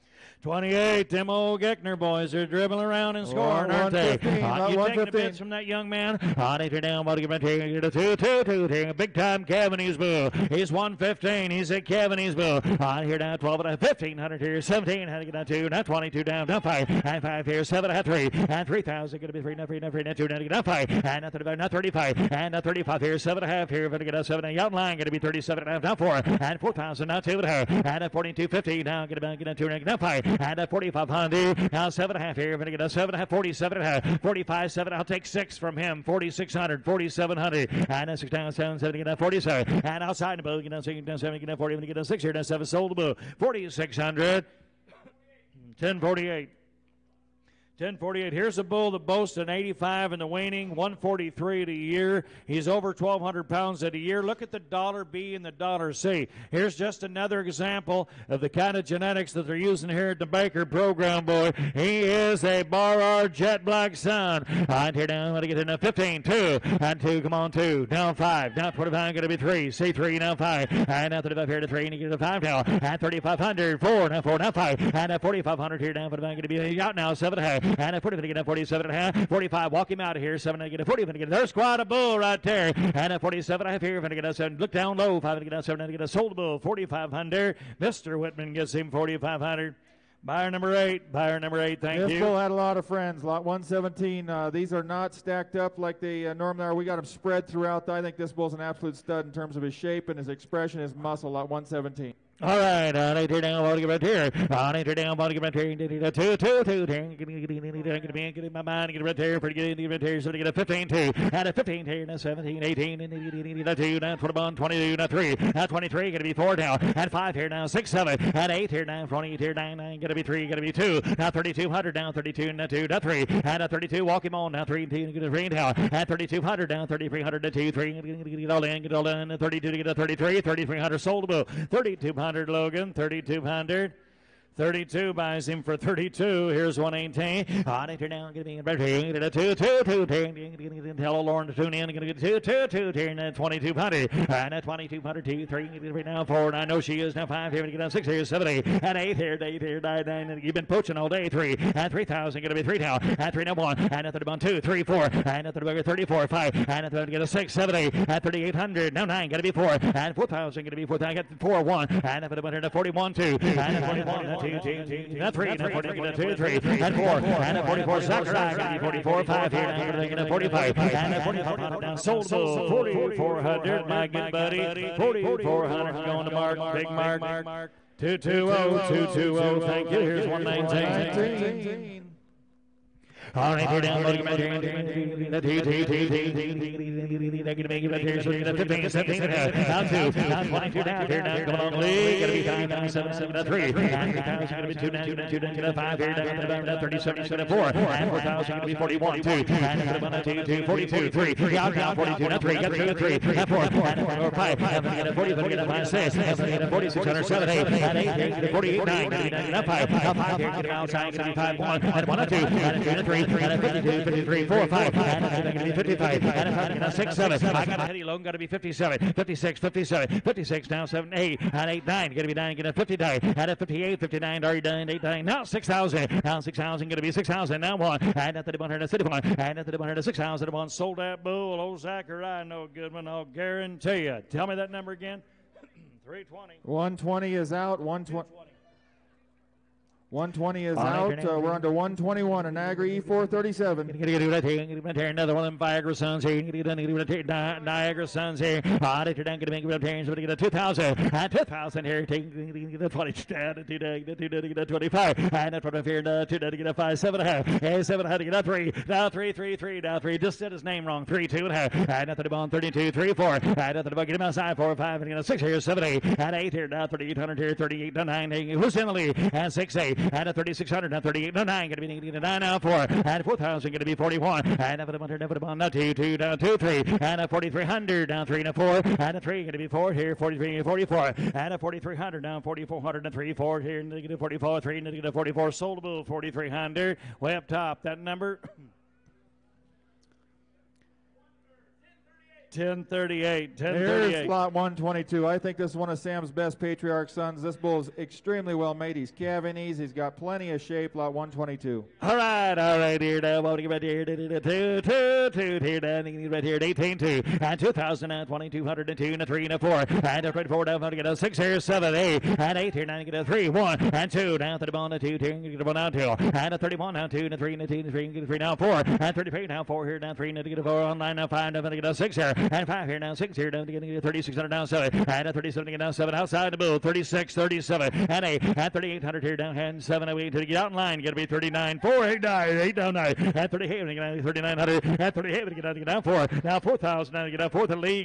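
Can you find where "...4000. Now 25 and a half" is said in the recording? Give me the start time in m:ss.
0:26.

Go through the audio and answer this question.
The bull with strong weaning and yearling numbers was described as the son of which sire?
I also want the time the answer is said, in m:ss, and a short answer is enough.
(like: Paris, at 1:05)
Bar R Jet Black, at 1:02.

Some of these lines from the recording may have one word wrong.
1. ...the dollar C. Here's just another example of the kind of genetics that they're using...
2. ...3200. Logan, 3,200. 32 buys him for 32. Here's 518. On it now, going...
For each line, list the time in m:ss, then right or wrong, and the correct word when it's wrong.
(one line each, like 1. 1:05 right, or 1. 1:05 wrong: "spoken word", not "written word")
1. 0:55 right
2. 2:11 wrong: "118", not "518".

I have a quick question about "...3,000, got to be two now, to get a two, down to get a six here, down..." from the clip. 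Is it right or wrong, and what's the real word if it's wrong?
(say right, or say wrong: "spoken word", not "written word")
wrong: "five", not "six".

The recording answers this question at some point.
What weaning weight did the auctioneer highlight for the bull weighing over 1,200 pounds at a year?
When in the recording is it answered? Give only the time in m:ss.
0:49.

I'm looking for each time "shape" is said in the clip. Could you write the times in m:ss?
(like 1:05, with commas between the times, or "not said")
1:39, 5:00.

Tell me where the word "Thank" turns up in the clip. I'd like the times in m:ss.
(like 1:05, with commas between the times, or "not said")
1:31, 2:59.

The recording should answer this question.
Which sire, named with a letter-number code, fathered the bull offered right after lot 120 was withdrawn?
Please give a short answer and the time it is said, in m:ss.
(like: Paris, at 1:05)
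Niagara E437, at 4:02.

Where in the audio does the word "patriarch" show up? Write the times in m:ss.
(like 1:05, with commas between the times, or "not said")
4:56.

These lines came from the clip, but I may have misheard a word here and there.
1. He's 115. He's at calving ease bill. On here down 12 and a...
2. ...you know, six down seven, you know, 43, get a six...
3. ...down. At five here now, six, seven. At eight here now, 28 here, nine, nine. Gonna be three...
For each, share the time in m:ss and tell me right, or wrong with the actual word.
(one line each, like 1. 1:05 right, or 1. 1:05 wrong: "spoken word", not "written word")
1. 0:10 right
2. 0:40 wrong: "40", not "43"
3. 1:56 right.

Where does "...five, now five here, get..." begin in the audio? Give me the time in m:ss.
3:29.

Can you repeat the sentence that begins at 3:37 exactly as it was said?
I got it heady long, got to be 57, 56, 57, 56 now 7, 8 and 8, 9.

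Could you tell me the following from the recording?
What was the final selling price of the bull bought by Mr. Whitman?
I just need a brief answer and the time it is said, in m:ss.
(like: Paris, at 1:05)
$4,500, at 1:27.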